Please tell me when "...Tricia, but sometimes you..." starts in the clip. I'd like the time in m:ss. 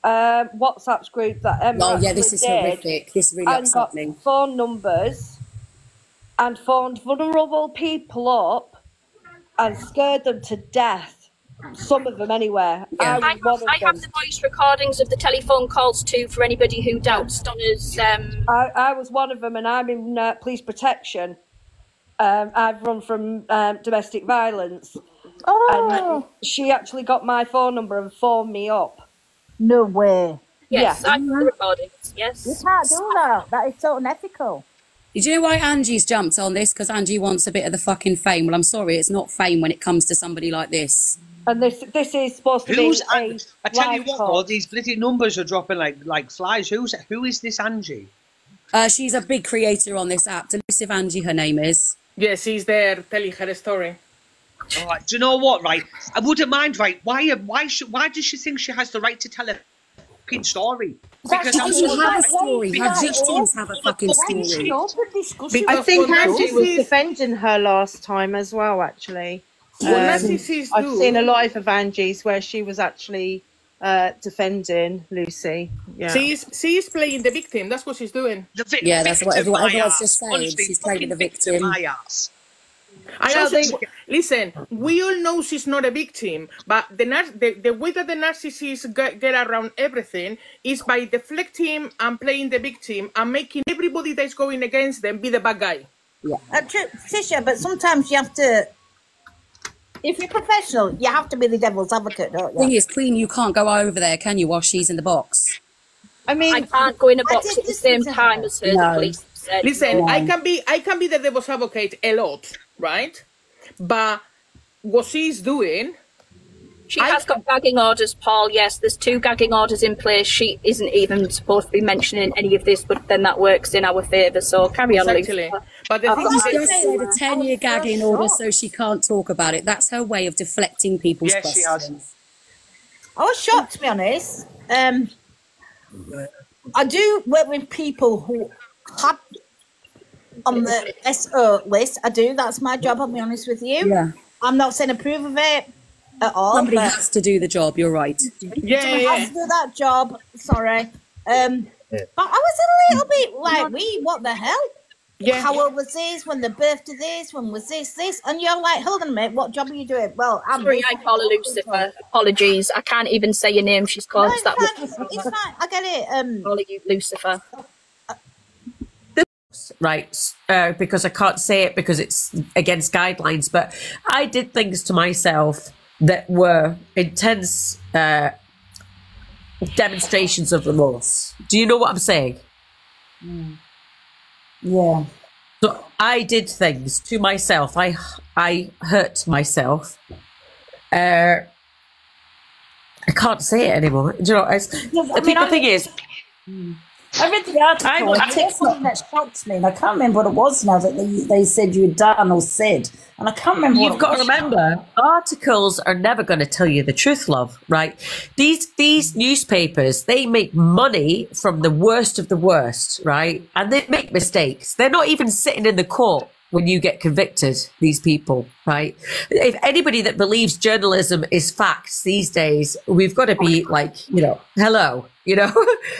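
1:36.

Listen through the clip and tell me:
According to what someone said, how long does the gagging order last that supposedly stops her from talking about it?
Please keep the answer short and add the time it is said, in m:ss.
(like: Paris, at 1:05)
10 years, at 2:07.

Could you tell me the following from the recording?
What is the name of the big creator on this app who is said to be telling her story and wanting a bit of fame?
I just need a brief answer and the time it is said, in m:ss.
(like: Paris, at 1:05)
Delusive Angie, at 0:50.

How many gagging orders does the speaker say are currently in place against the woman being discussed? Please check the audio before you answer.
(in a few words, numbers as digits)
2.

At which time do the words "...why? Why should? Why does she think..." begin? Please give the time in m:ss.
0:57.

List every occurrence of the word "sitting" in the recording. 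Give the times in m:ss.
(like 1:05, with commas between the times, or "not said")
3:35.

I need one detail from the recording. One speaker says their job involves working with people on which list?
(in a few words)
SO list.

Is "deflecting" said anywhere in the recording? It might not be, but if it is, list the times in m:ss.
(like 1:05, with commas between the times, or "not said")
1:31, 2:10.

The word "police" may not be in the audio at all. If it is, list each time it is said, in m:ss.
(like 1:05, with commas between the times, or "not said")
0:20, 1:48.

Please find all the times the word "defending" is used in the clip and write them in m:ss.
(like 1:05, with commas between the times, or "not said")
1:06, 1:14.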